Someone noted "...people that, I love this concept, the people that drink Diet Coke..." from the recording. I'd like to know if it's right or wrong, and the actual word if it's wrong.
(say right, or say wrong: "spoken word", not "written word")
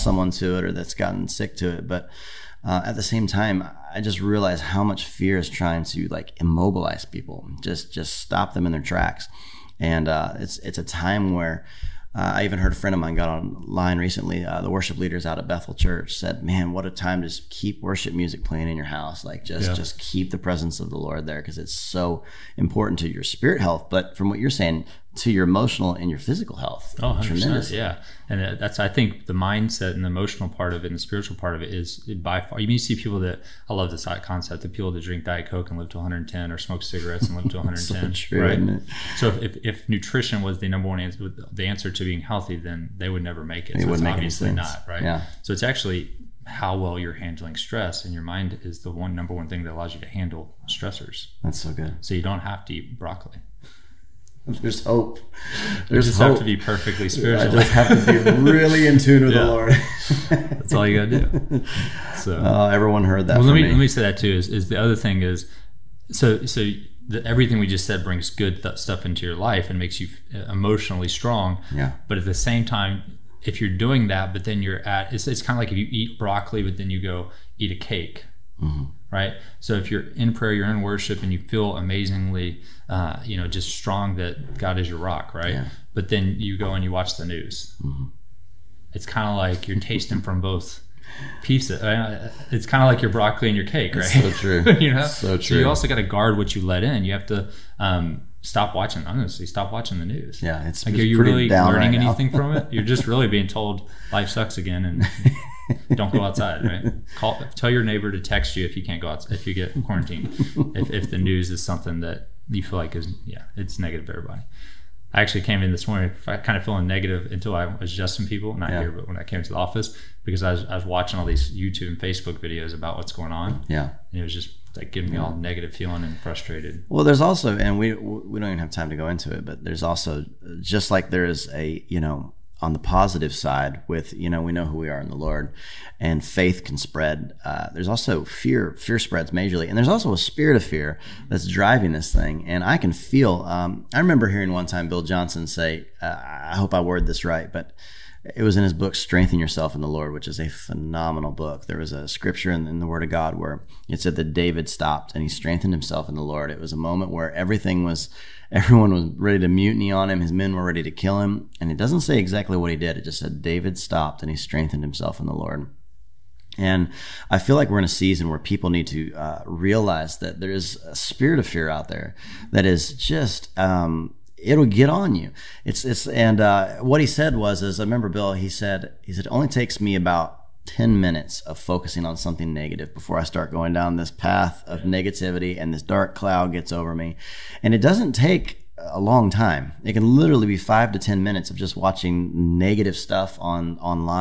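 right.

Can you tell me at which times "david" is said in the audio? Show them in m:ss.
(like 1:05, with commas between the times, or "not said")
2:34, 2:43.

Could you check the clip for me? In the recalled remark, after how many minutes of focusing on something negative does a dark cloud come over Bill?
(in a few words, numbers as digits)
10.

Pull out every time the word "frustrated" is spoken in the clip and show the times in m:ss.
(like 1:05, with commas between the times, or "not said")
2:06.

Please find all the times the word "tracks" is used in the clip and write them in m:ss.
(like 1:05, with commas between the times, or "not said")
0:08.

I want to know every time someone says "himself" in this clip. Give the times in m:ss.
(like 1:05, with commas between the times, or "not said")
2:35, 2:44.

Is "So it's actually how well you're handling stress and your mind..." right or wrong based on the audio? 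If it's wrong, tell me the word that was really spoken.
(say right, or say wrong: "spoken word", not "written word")
right.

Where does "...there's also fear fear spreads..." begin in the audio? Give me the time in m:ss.
2:17.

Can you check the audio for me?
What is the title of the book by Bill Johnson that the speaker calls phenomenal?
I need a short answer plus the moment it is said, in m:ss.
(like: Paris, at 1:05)
Strengthen Yourself in the Lord, at 2:28.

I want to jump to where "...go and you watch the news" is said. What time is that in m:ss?
1:26.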